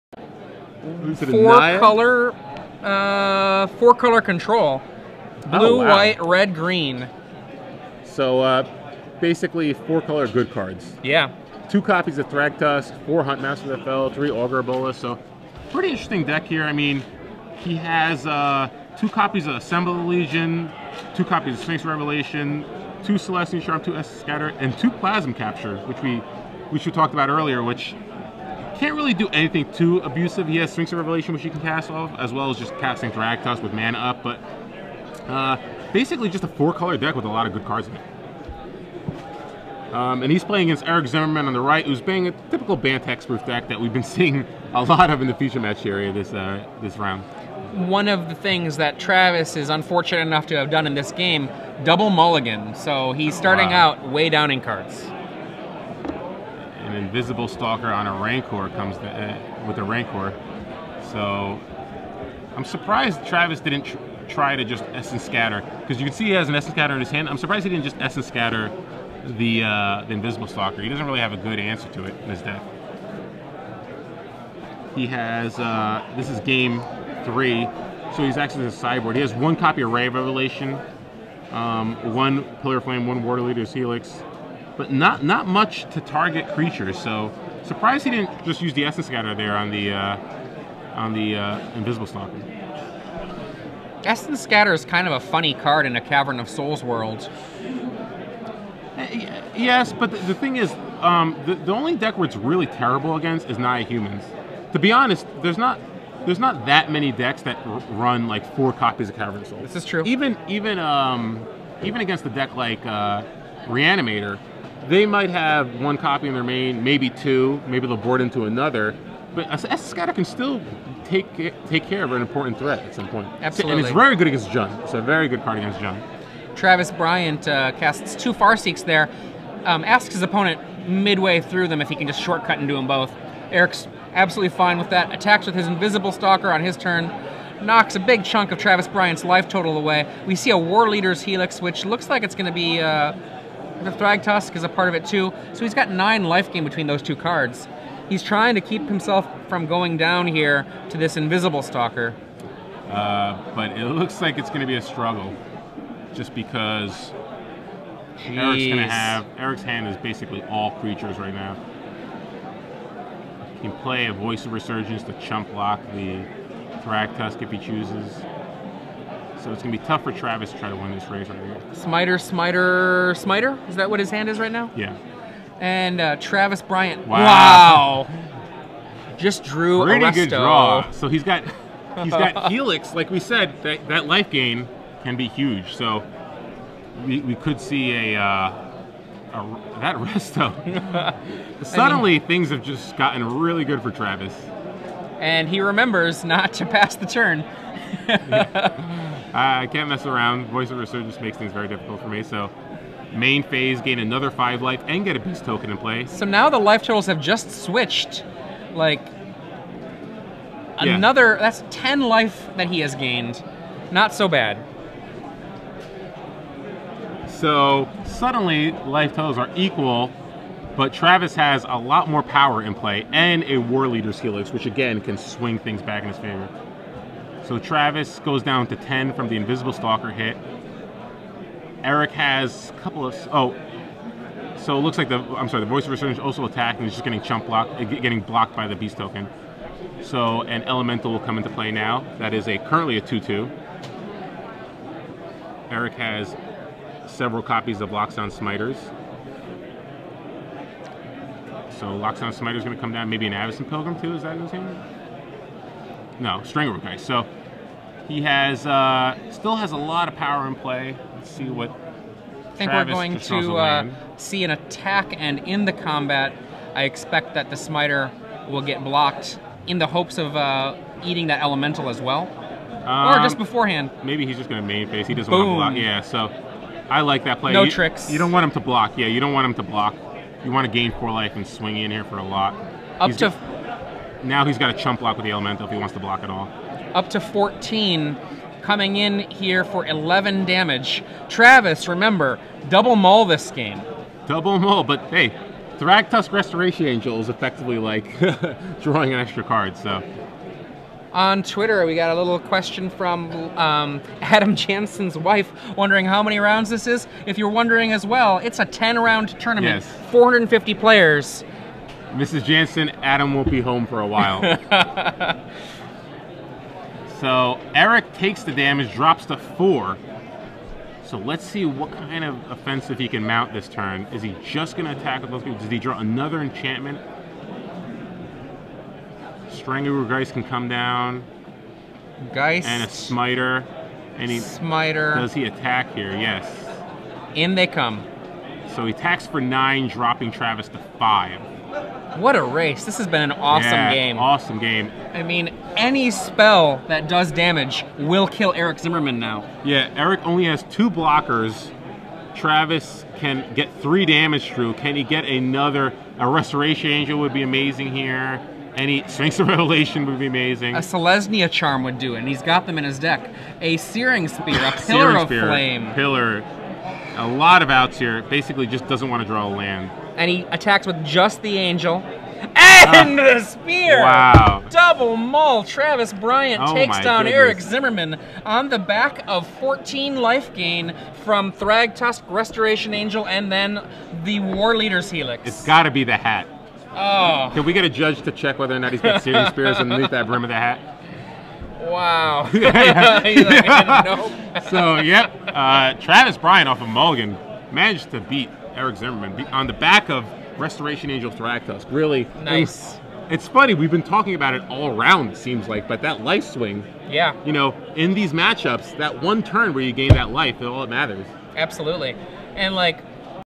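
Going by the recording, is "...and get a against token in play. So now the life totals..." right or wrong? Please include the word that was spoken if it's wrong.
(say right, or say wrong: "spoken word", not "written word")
wrong: "beast", not "against".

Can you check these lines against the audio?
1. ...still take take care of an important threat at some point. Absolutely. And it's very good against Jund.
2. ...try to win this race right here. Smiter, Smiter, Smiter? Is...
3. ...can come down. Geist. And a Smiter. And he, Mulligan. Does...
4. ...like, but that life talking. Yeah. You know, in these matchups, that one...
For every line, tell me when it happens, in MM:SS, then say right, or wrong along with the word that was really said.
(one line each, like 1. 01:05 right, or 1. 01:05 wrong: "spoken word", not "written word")
1. 02:00 right
2. 02:50 right
3. 05:30 wrong: "Smiter", not "Mulligan"
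4. 06:45 wrong: "swing", not "talking".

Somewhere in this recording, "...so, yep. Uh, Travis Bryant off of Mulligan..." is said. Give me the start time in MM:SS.
06:34.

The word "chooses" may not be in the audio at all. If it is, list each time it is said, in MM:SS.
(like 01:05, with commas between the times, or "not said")
02:47.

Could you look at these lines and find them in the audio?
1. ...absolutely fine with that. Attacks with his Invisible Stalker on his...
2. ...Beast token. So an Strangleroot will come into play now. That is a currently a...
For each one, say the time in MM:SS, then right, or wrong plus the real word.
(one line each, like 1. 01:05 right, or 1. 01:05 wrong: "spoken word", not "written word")
1. 02:14 right
2. 03:58 wrong: "Elemental", not "Strangleroot".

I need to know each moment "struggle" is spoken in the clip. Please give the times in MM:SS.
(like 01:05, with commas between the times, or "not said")
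02:34.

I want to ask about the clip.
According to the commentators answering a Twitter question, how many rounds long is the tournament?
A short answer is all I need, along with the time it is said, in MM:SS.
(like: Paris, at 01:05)
10, at 05:08.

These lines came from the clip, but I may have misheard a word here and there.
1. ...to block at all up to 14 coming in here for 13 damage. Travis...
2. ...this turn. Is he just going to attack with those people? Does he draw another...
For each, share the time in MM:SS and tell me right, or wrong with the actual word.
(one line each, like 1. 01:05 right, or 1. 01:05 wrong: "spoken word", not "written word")
1. 04:45 wrong: "11", not "13"
2. 05:23 right.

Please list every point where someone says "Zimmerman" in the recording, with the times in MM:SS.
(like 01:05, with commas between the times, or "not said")
00:41, 05:48, 06:17, 06:38.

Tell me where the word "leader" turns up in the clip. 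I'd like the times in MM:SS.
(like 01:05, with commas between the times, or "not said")
01:23, 02:20, 03:43, 06:24.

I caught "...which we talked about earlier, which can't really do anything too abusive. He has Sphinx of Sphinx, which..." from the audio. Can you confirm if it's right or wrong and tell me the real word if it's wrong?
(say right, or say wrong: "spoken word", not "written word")
wrong: "Revelation", not "Sphinx".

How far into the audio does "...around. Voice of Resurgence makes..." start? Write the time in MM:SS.
03:20.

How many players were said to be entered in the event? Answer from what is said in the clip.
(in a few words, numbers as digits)
450.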